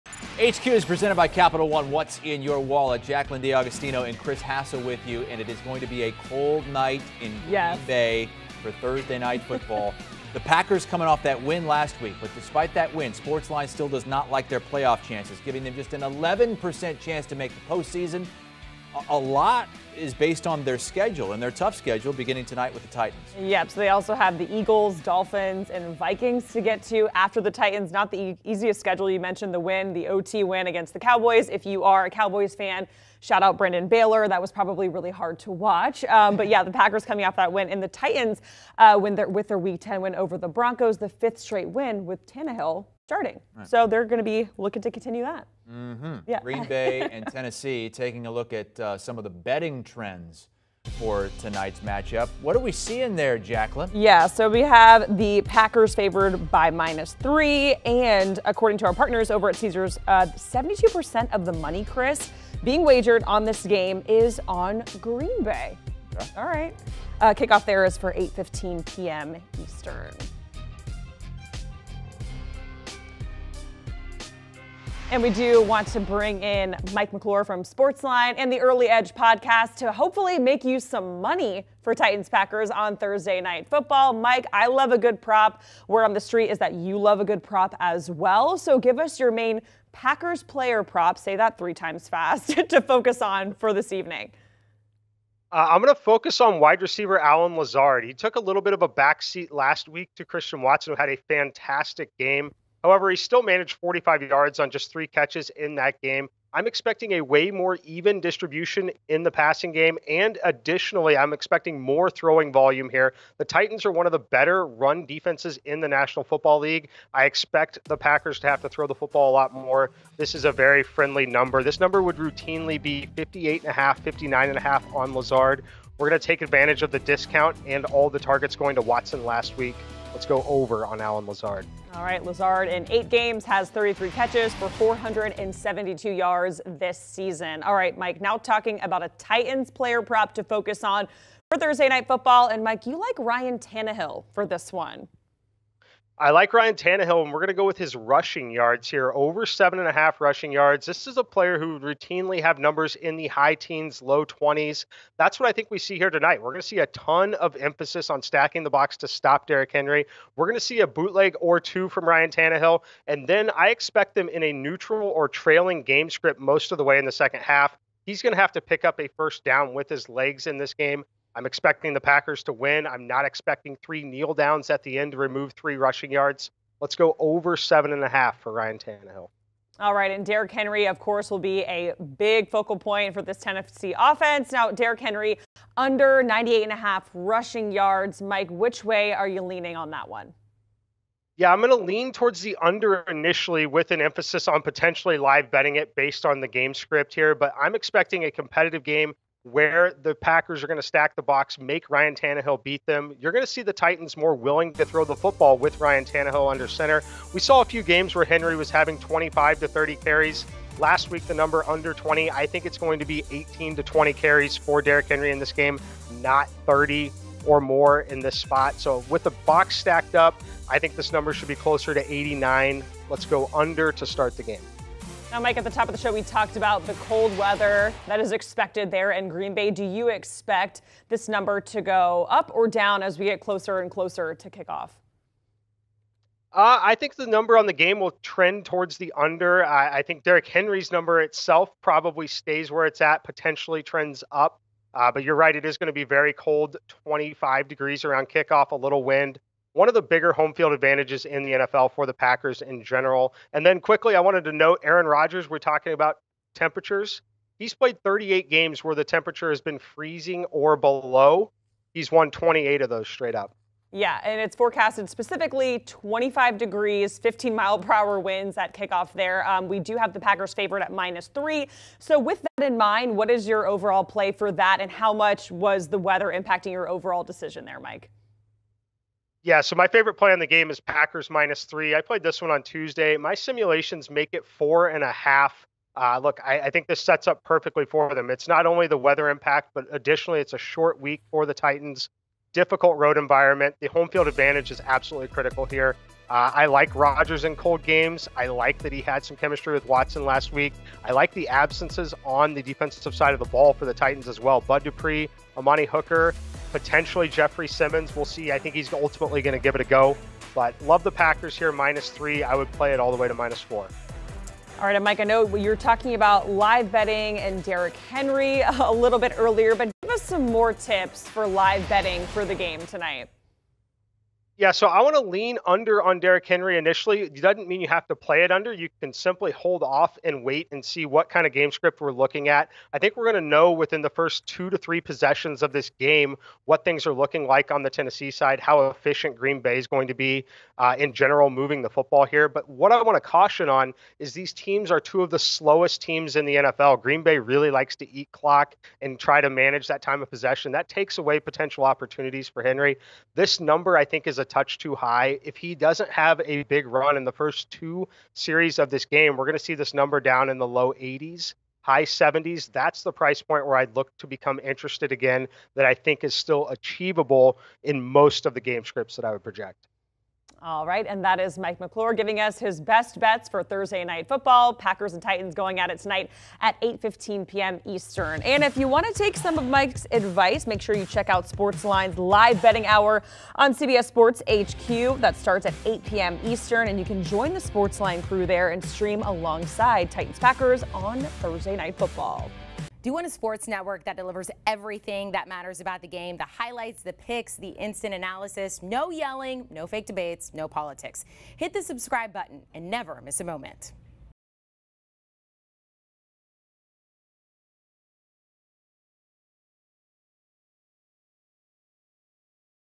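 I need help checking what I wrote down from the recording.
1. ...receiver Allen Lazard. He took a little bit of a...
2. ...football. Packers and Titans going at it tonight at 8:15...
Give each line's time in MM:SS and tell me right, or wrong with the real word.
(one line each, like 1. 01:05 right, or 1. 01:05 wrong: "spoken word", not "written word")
1. 01:36 right
2. 06:14 right.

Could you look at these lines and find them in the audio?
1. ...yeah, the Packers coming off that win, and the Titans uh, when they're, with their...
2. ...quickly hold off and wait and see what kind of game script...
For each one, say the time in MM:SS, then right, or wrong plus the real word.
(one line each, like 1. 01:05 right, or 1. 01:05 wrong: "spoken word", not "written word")
1. 00:36 right
2. 05:29 wrong: "simply", not "quickly".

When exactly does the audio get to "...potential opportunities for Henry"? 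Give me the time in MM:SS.
05:51.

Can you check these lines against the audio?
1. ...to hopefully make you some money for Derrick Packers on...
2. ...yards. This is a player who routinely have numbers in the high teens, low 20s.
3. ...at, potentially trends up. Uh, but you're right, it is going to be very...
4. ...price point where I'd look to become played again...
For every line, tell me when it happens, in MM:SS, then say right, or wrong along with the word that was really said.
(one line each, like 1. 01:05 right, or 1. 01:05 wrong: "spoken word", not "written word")
1. 01:19 wrong: "Titans", not "Derrick"
2. 02:30 right
3. 04:02 right
4. 06:03 wrong: "interested", not "played".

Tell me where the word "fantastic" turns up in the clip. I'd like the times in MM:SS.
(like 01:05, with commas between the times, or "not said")
01:41.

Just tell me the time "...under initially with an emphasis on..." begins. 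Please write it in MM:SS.
03:12.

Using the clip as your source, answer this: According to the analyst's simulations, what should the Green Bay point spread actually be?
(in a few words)
4.5.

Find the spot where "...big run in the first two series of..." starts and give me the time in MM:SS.
05:56.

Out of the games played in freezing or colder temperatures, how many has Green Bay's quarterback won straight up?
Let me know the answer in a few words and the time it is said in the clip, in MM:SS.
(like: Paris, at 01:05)
28, at 04:22.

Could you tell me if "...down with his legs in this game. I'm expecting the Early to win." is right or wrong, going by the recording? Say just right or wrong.
wrong.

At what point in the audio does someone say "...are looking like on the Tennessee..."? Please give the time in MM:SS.
05:37.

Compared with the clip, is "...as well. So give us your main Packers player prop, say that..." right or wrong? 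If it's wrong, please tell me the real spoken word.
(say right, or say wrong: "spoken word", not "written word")
right.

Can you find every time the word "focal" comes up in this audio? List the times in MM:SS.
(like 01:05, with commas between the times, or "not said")
03:02.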